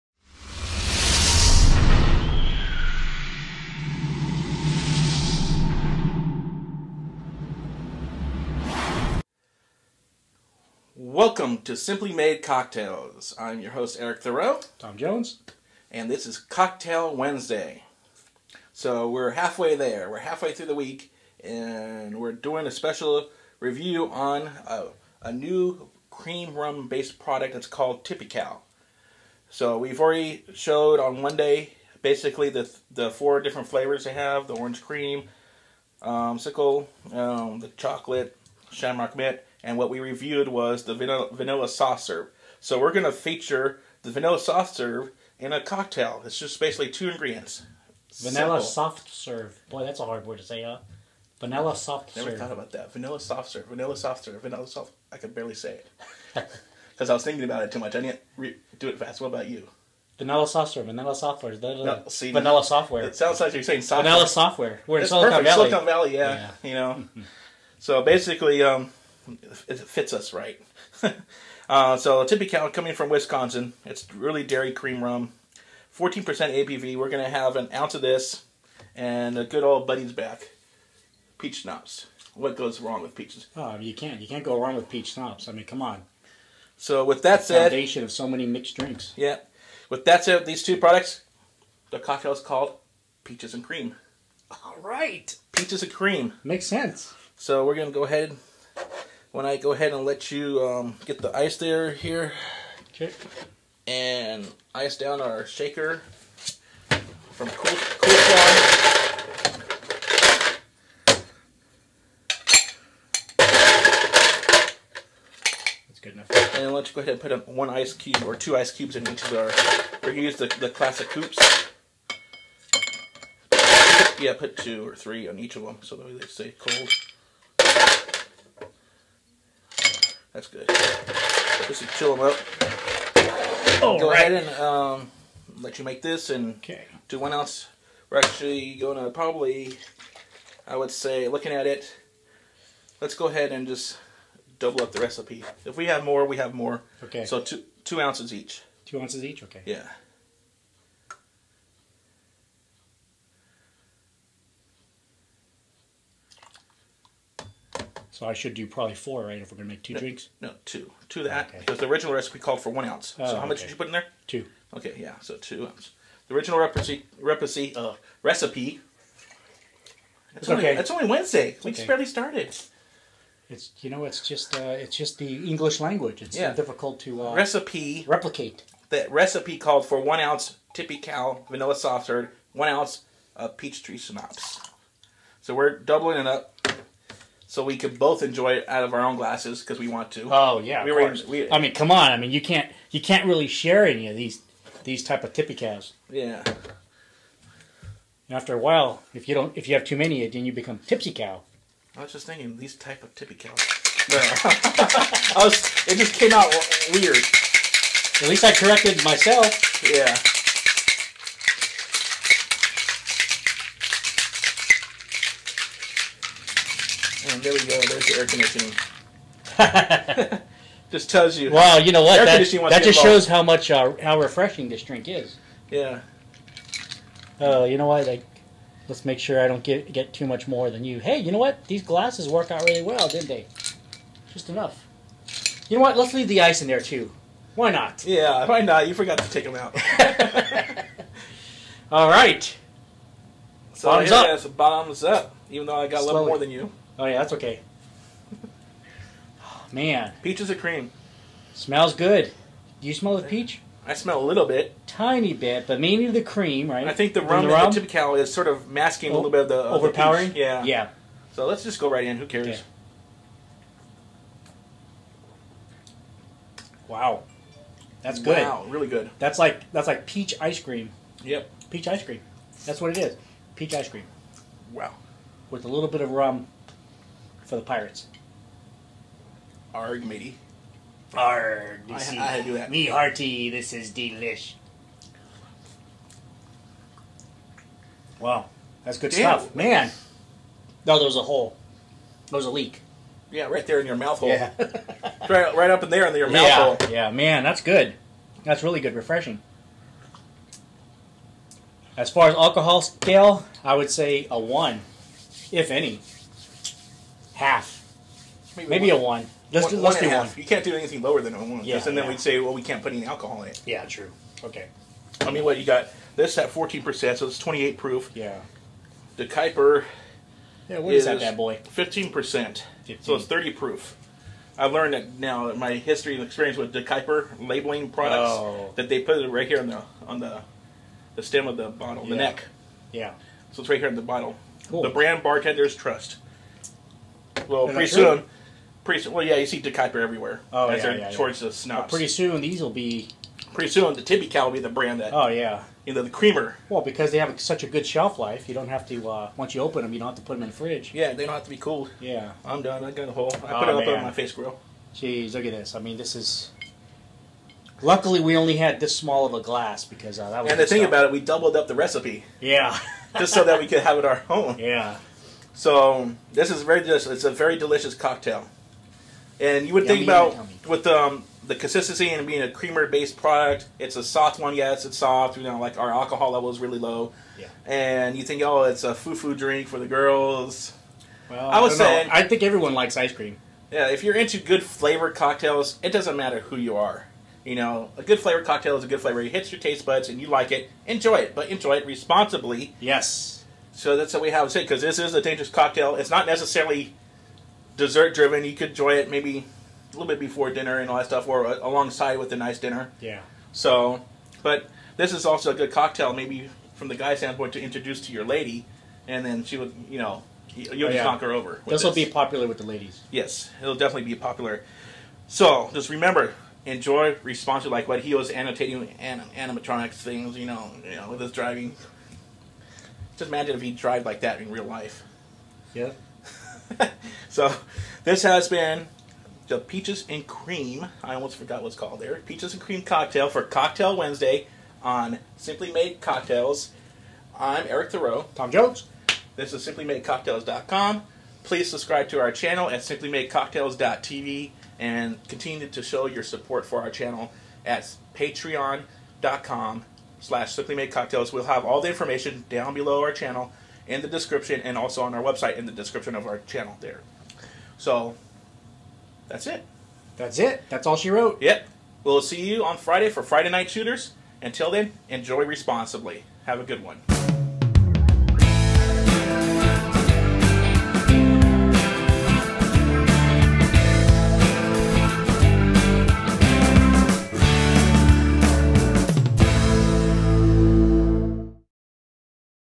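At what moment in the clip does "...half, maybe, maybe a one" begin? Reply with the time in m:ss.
5:07.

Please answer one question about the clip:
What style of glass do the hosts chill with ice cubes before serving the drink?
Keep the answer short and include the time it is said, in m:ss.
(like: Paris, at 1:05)
coupes, at 2:00.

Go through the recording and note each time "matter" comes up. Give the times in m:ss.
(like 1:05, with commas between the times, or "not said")
6:26.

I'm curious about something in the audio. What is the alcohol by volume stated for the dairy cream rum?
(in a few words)
14%.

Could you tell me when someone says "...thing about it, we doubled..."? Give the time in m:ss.
6:00.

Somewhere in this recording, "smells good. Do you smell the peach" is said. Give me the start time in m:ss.
4:11.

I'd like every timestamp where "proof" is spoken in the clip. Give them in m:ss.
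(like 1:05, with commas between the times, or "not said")
5:17, 5:23.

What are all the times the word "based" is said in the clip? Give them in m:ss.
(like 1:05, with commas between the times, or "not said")
0:26, 6:12.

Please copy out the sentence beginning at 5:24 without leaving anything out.
I learned that now my history and experience with DeKuyper labeling products oh.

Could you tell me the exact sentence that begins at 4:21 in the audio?
So let's just go right in.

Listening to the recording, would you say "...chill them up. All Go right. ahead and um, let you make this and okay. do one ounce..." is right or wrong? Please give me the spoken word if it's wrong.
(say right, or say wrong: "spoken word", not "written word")
right.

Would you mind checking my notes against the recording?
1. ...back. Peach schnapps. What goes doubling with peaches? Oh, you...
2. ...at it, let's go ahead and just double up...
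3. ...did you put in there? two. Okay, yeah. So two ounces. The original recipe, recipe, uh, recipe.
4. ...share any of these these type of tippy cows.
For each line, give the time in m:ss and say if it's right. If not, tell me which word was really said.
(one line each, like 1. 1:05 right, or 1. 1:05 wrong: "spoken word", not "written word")
1. 1:20 wrong: "wrong", not "doubling"
2. 2:21 right
3. 2:43 right
4. 3:13 right.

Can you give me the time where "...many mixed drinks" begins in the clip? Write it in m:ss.
1:28.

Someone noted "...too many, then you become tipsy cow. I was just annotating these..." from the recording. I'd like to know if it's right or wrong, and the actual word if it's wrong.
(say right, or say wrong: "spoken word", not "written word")
wrong: "thinking", not "annotating".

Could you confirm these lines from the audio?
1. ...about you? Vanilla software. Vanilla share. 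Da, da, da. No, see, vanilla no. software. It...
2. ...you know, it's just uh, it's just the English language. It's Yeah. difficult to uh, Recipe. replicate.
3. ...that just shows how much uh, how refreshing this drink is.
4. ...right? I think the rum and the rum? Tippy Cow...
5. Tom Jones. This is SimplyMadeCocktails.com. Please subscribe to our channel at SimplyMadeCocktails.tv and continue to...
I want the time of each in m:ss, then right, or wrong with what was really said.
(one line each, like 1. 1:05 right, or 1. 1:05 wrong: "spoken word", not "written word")
1. 0:59 wrong: "software", not "share"
2. 2:53 right
3. 3:42 right
4. 4:16 right
5. 7:18 right.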